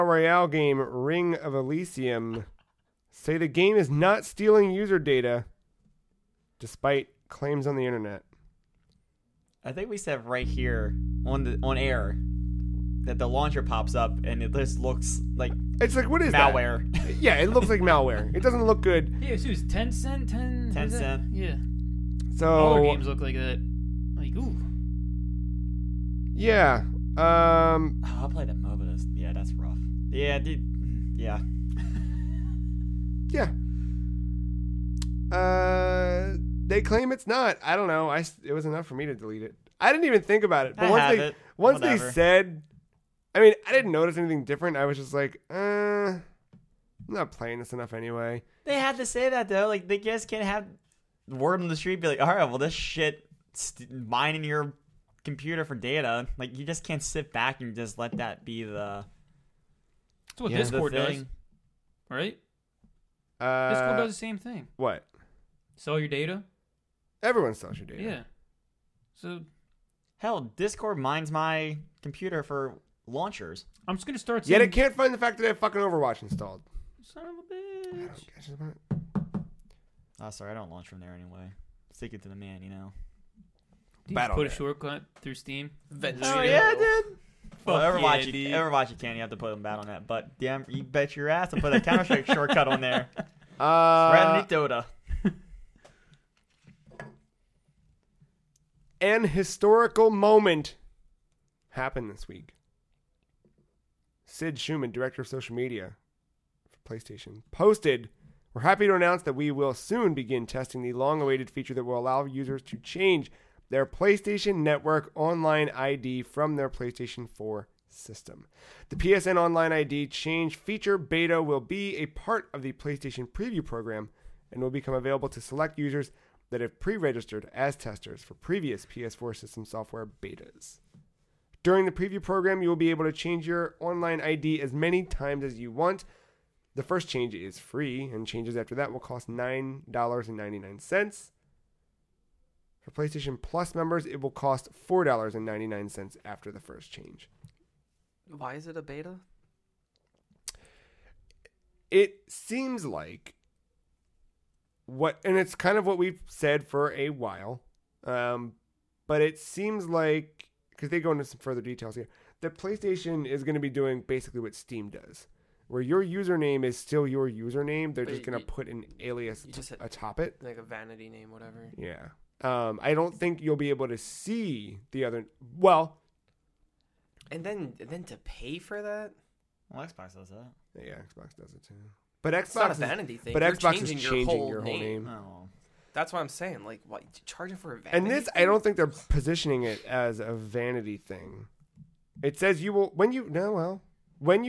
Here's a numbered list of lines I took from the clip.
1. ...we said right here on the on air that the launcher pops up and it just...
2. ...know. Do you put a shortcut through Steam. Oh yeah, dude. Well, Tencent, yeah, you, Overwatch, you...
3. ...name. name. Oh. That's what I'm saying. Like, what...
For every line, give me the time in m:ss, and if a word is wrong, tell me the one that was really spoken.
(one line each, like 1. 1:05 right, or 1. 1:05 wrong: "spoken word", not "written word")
1. 0:09 right
2. 1:22 wrong: "Overwatch", not "Tencent"
3. 3:04 right.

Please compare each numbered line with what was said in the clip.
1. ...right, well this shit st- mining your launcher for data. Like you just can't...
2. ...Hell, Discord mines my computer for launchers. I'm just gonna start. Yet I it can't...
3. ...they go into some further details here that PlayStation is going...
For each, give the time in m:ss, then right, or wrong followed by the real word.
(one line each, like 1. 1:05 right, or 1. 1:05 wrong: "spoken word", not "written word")
1. 0:52 wrong: "computer", not "launcher"
2. 1:10 right
3. 2:40 right.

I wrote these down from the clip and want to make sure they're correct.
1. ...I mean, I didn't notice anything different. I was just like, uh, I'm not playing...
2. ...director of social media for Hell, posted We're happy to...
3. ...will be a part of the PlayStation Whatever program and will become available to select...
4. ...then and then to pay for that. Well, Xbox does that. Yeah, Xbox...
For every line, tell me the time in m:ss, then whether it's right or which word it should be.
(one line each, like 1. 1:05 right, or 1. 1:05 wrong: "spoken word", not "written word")
1. 0:43 right
2. 1:44 wrong: "PlayStation", not "Hell"
3. 2:01 wrong: "Preview", not "Whatever"
4. 2:57 right.